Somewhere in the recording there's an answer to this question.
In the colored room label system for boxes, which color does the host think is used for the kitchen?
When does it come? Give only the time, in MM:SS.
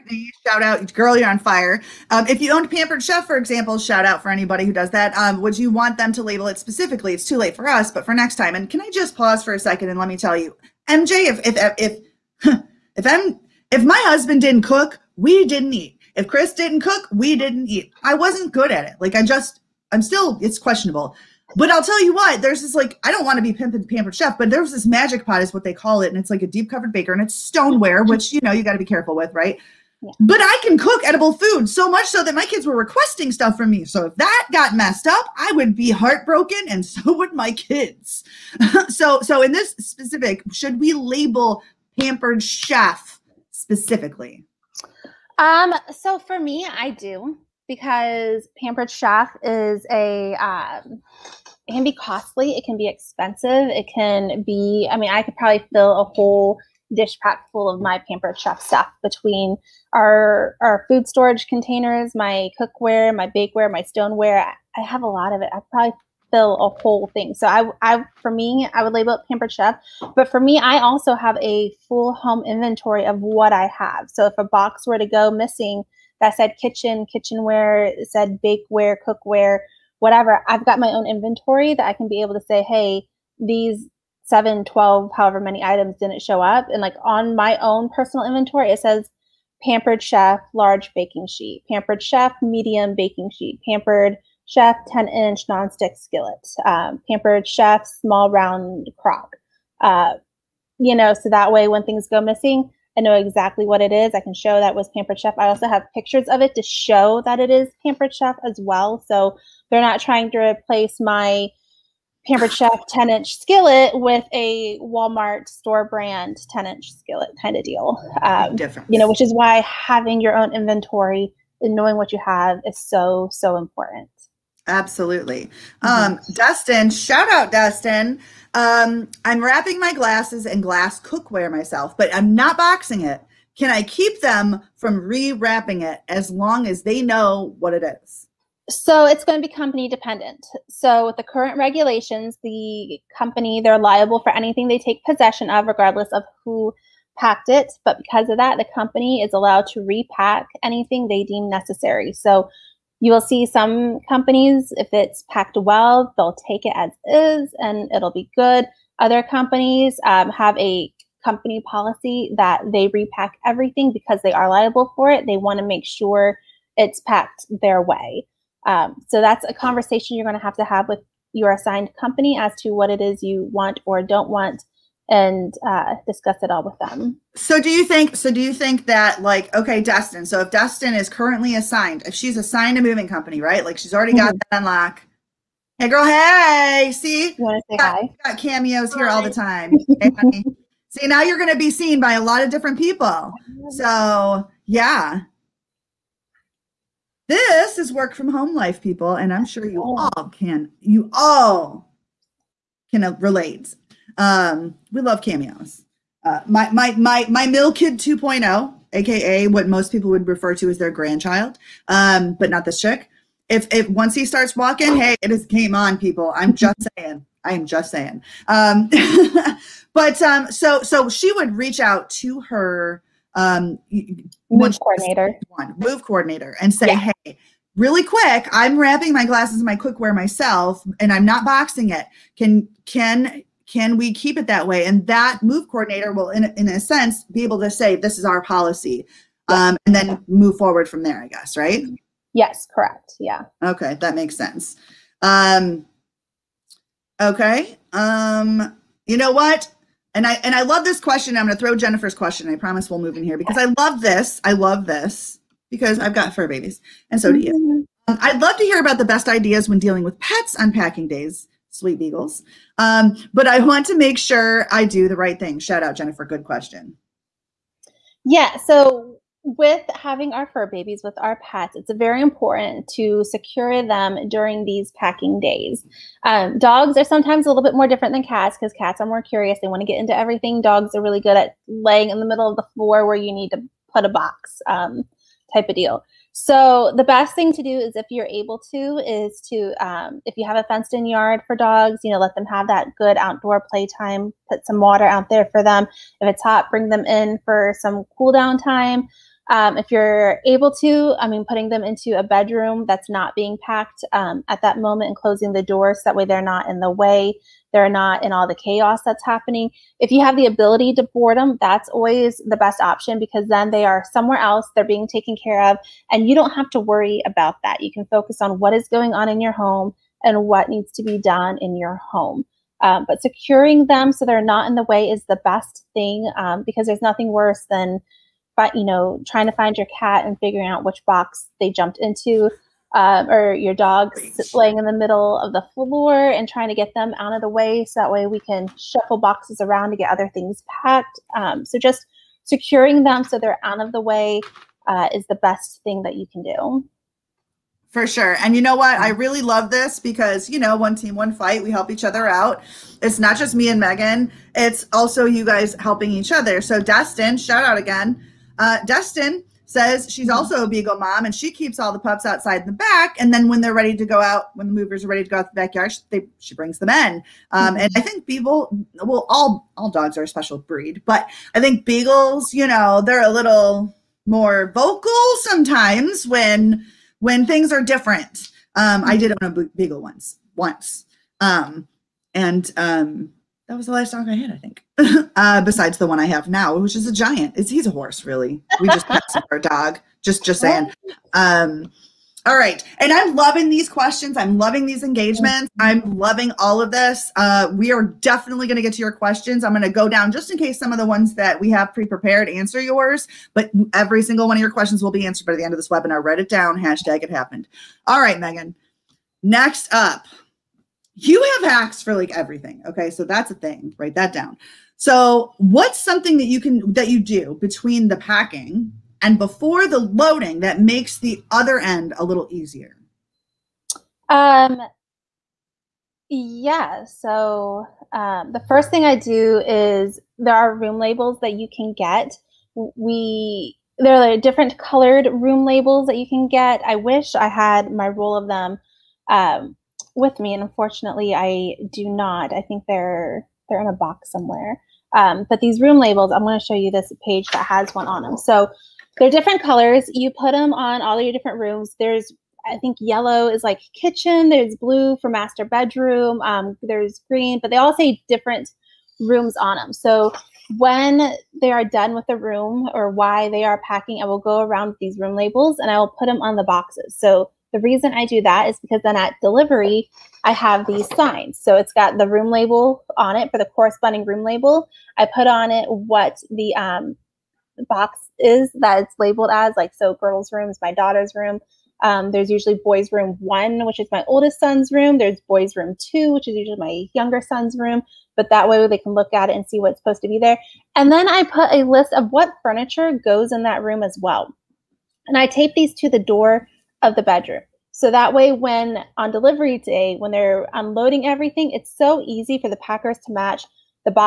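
07:32.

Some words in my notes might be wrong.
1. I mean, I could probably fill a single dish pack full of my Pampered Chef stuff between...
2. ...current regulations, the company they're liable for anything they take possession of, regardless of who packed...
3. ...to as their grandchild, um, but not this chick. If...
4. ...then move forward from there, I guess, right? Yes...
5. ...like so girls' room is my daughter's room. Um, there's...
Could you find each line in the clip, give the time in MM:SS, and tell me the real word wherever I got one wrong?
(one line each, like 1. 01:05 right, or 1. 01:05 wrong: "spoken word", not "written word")
1. 00:54 wrong: "whole", not "single"
2. 02:21 right
3. 03:30 right
4. 03:59 right
5. 07:59 right.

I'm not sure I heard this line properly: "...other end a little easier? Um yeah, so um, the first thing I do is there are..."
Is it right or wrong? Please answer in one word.
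right.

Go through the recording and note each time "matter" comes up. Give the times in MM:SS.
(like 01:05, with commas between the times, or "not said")
not said.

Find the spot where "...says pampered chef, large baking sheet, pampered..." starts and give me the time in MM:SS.
01:28.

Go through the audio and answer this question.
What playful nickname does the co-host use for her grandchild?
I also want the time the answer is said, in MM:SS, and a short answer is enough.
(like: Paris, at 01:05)
mill kid 2.0, at 03:27.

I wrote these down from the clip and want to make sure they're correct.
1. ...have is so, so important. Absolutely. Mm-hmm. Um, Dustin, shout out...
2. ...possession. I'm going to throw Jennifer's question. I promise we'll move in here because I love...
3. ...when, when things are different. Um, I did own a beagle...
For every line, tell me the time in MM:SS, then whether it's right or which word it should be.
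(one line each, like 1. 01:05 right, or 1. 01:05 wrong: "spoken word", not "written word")
1. 02:02 right
2. 04:10 wrong: "question", not "possession"
3. 06:16 right.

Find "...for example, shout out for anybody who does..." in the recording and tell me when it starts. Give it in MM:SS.
00:03.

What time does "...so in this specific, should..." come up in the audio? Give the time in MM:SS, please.
00:39.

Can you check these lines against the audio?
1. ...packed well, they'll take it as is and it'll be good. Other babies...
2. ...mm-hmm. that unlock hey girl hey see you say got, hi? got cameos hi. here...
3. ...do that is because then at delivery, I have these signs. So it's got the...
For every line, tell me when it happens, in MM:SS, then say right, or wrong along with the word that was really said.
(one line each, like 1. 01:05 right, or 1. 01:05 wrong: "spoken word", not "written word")
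1. 02:35 wrong: "companies", not "babies"
2. 03:04 right
3. 07:48 right.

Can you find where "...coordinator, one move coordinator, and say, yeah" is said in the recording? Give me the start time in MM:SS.
03:44.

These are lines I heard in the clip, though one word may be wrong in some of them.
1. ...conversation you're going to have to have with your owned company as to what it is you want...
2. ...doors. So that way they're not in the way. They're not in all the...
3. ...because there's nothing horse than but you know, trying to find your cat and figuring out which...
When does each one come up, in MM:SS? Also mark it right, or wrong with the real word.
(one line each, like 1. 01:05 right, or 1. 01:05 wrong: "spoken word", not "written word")
1. 02:49 wrong: "assigned", not "owned"
2. 05:05 right
3. 05:26 wrong: "worse", not "horse".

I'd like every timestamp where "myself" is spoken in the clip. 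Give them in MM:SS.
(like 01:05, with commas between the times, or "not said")
02:11, 03:50.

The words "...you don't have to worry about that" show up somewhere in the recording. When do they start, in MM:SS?
05:16.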